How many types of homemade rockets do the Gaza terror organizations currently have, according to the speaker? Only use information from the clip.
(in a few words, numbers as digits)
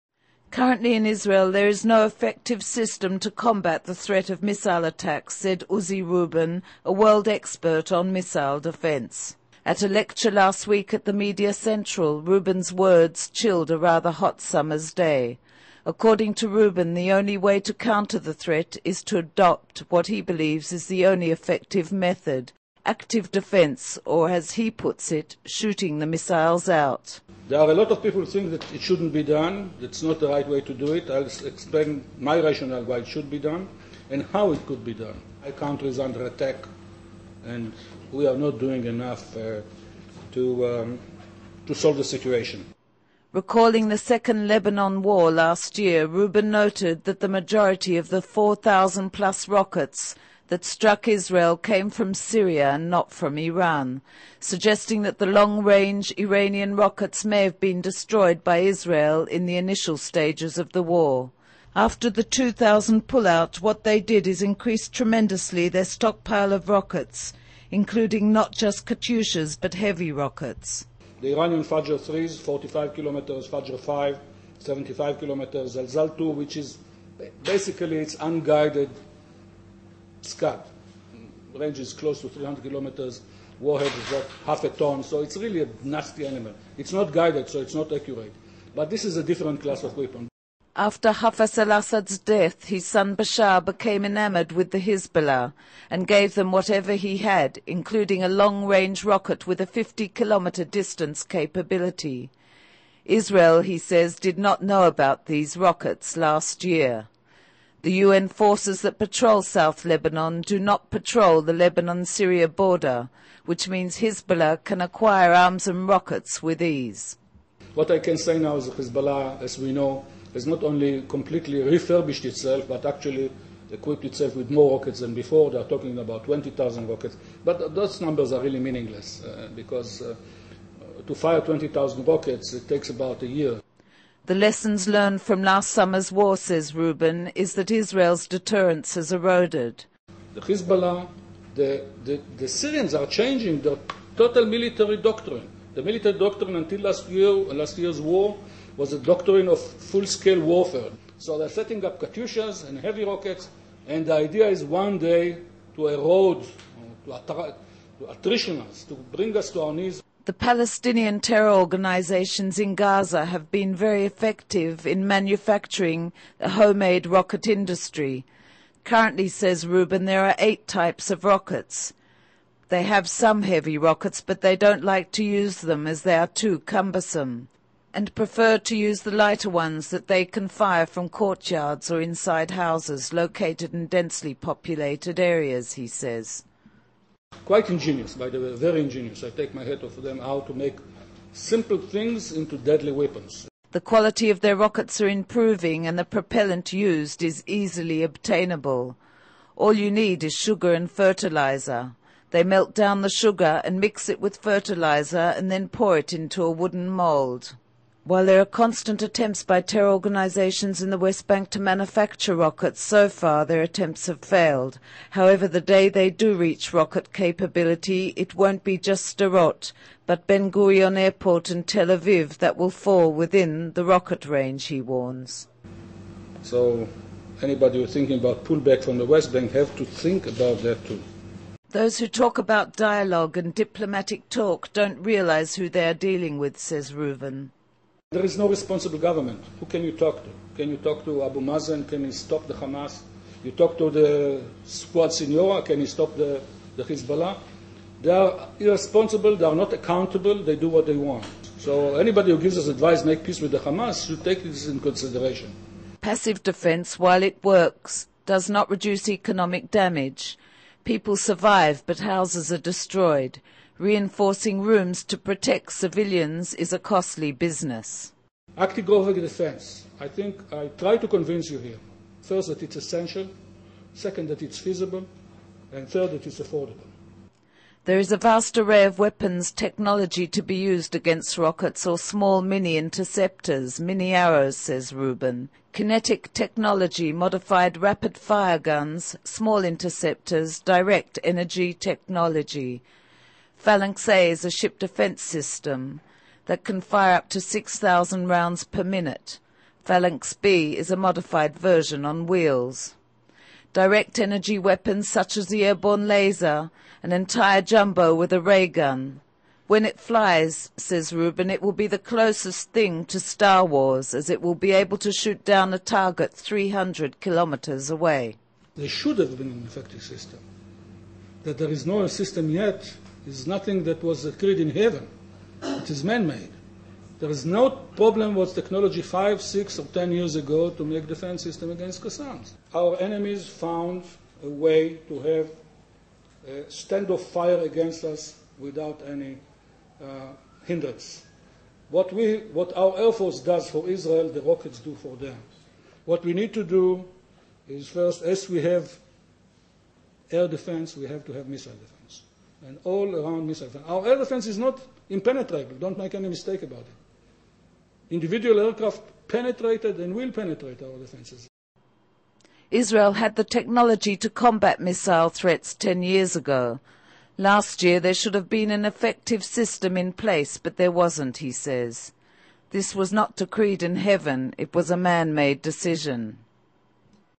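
8.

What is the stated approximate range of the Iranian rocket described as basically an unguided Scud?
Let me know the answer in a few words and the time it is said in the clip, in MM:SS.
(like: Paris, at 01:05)
300 kilometers, at 01:21.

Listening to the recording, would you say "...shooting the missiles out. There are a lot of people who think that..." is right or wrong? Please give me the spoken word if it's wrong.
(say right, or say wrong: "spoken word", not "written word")
right.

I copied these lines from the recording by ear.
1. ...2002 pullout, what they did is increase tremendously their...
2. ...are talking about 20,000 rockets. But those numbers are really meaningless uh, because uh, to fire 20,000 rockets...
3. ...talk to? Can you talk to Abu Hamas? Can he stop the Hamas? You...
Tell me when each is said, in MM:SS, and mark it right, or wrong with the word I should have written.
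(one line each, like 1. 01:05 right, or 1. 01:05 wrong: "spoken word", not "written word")
1. 01:02 wrong: "2000", not "2002"
2. 02:05 right
3. 03:59 wrong: "Mazen", not "Hamas".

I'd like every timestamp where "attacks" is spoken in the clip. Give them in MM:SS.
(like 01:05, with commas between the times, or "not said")
00:04, 00:36.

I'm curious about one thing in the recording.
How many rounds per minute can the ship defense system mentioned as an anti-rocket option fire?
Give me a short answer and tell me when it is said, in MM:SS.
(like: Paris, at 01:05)
6,000, at 04:57.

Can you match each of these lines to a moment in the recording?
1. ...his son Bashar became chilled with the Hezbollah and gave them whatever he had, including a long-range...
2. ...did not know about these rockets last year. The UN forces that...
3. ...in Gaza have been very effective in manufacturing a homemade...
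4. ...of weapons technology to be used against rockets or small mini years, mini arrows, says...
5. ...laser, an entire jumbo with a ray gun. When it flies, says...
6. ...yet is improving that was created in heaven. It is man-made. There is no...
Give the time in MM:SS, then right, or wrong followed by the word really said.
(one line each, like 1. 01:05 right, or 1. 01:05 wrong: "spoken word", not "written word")
1. 01:32 wrong: "enamored", not "chilled"
2. 01:44 right
3. 02:42 right
4. 04:38 wrong: "interceptors", not "years"
5. 05:06 right
6. 05:22 wrong: "nothing", not "improving".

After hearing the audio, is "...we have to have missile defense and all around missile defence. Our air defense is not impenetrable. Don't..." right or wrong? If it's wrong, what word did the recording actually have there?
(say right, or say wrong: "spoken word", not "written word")
right.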